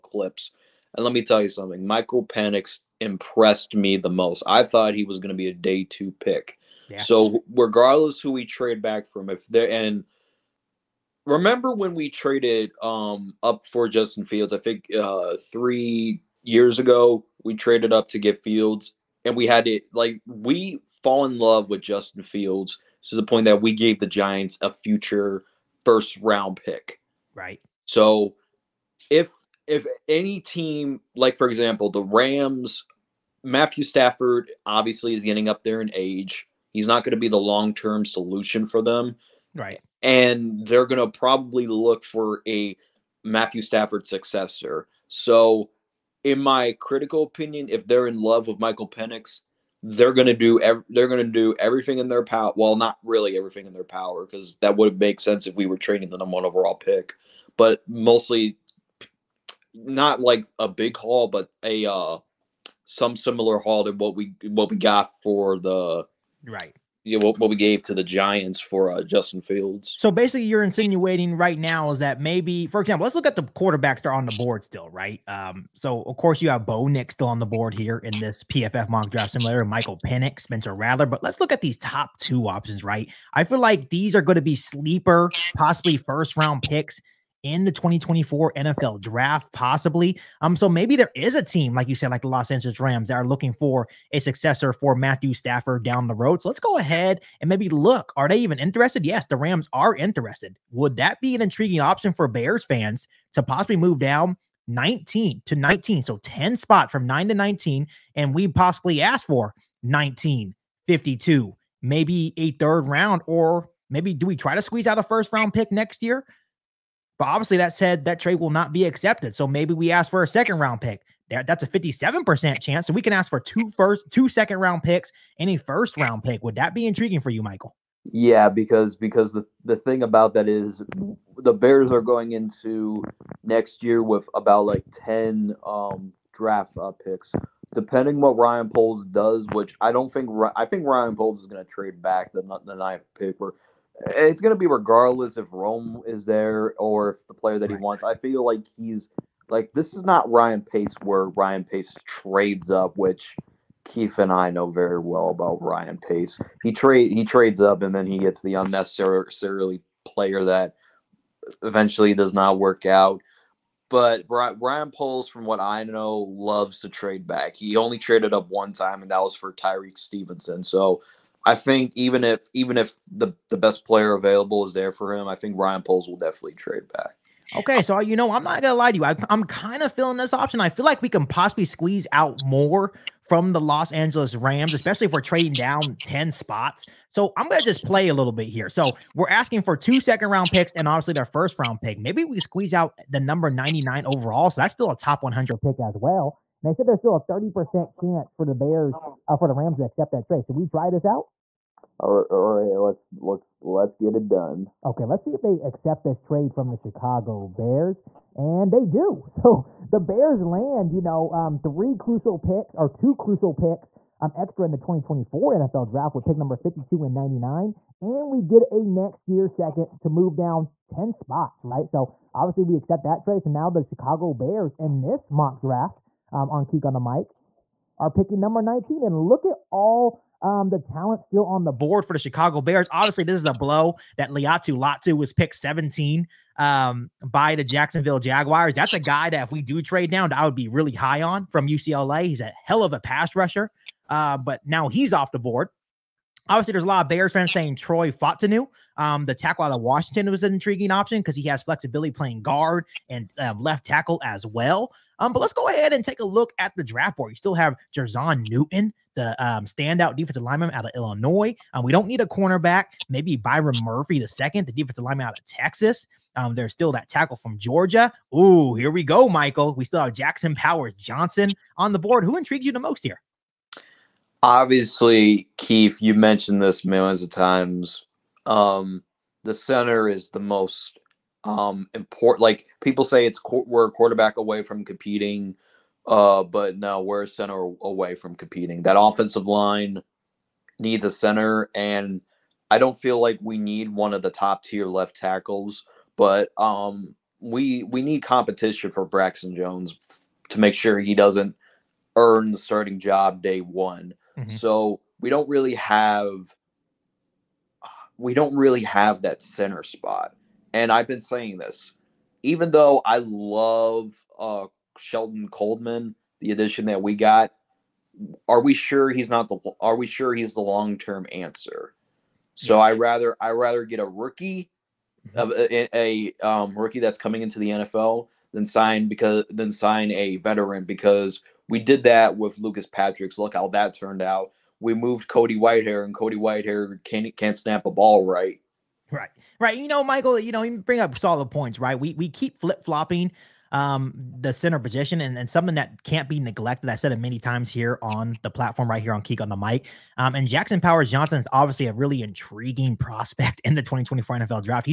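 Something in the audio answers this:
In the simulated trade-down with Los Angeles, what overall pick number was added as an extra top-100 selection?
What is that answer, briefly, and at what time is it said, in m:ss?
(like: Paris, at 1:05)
99, at 3:13.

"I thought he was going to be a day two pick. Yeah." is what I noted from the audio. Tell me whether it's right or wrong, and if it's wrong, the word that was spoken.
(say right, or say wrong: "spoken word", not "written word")
right.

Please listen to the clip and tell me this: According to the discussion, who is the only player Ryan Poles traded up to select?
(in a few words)
Tyrique Stevenson.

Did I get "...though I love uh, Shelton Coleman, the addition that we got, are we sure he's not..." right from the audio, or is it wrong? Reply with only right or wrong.
right.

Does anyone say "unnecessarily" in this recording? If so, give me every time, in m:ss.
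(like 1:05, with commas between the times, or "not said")
2:38.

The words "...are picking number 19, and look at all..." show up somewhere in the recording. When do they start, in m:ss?
3:47.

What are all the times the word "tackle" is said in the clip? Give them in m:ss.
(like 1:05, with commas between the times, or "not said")
4:09, 4:13, 4:27, 4:55.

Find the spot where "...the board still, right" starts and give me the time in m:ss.
1:14.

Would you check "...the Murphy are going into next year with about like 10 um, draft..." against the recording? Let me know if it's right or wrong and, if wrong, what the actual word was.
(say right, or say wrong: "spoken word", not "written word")
wrong: "Bears", not "Murphy".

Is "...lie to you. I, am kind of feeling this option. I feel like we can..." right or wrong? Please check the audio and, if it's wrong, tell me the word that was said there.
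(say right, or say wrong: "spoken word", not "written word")
right.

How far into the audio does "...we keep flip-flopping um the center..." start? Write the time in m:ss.
5:42.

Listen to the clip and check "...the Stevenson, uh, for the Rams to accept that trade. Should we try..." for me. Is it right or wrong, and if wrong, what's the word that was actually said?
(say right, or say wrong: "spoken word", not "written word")
wrong: "Bears", not "Stevenson".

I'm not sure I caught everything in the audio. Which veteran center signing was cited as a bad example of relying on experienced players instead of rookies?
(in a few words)
Lucas Patrick.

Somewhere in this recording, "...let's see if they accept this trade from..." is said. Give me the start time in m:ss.
3:25.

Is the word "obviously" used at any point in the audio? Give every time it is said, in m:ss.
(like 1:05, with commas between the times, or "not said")
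0:34, 1:57, 3:10, 3:42, 3:52, 4:06, 4:34, 5:51.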